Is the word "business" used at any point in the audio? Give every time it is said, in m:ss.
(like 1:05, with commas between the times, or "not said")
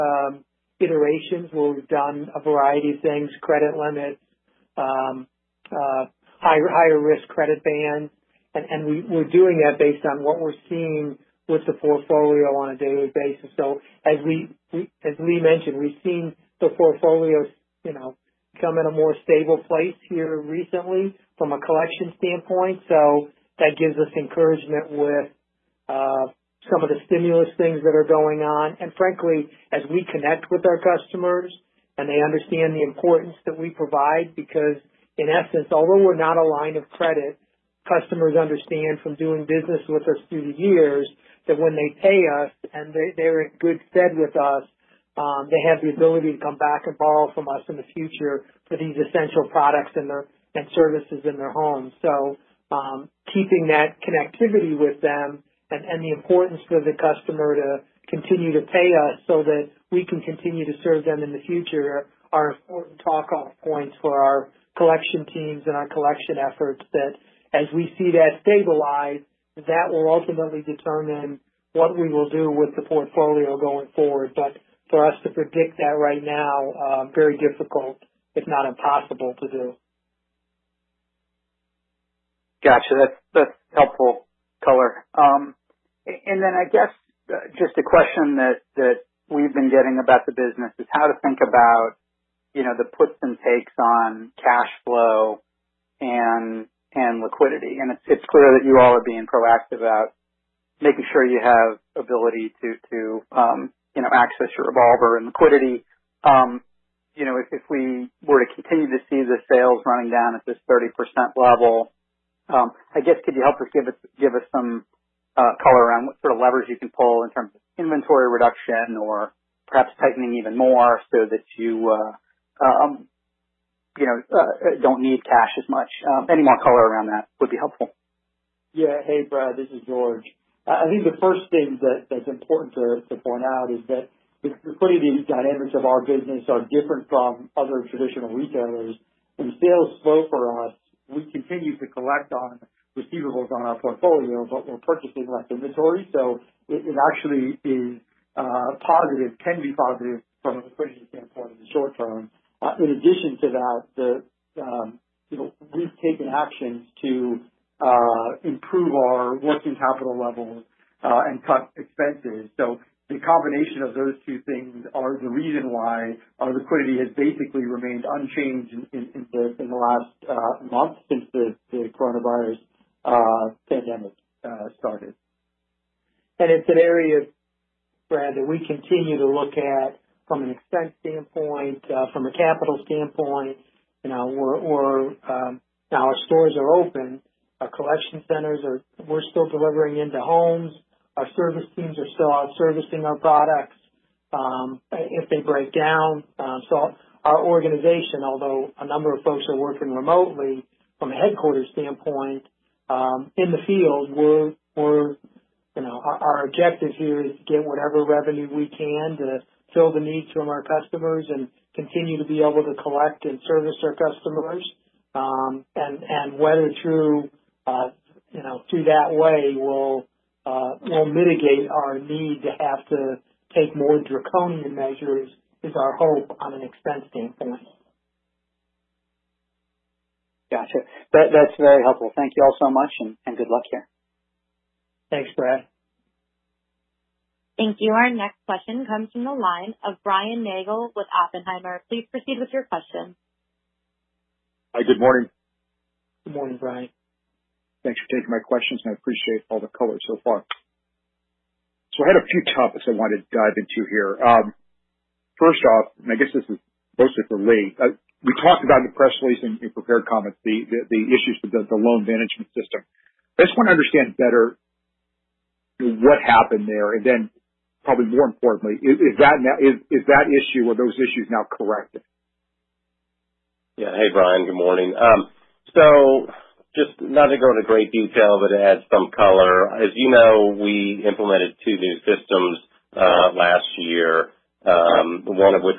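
0:39, 1:30, 2:16.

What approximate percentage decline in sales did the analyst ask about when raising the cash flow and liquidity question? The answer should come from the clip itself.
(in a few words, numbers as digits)
30%.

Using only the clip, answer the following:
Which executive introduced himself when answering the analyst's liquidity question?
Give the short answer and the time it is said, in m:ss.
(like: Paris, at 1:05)
George, at 2:09.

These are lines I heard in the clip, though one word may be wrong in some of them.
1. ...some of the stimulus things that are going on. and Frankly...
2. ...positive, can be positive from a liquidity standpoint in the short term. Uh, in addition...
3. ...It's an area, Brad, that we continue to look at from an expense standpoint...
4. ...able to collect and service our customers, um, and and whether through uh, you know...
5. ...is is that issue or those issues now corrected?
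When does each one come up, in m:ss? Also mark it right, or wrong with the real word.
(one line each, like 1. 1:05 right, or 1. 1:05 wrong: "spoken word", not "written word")
1. 0:26 right
2. 2:28 right
3. 2:56 right
4. 3:32 right
5. 4:29 right.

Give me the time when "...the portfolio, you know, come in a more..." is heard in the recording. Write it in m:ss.
0:16.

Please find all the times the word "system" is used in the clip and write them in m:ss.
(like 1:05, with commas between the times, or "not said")
4:22, 4:42.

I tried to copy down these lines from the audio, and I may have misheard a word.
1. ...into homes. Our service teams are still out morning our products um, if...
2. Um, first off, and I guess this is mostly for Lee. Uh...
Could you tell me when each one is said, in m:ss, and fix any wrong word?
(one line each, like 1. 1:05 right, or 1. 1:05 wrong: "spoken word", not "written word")
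1. 3:09 wrong: "servicing", not "morning"
2. 4:14 right.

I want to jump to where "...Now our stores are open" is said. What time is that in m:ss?
3:05.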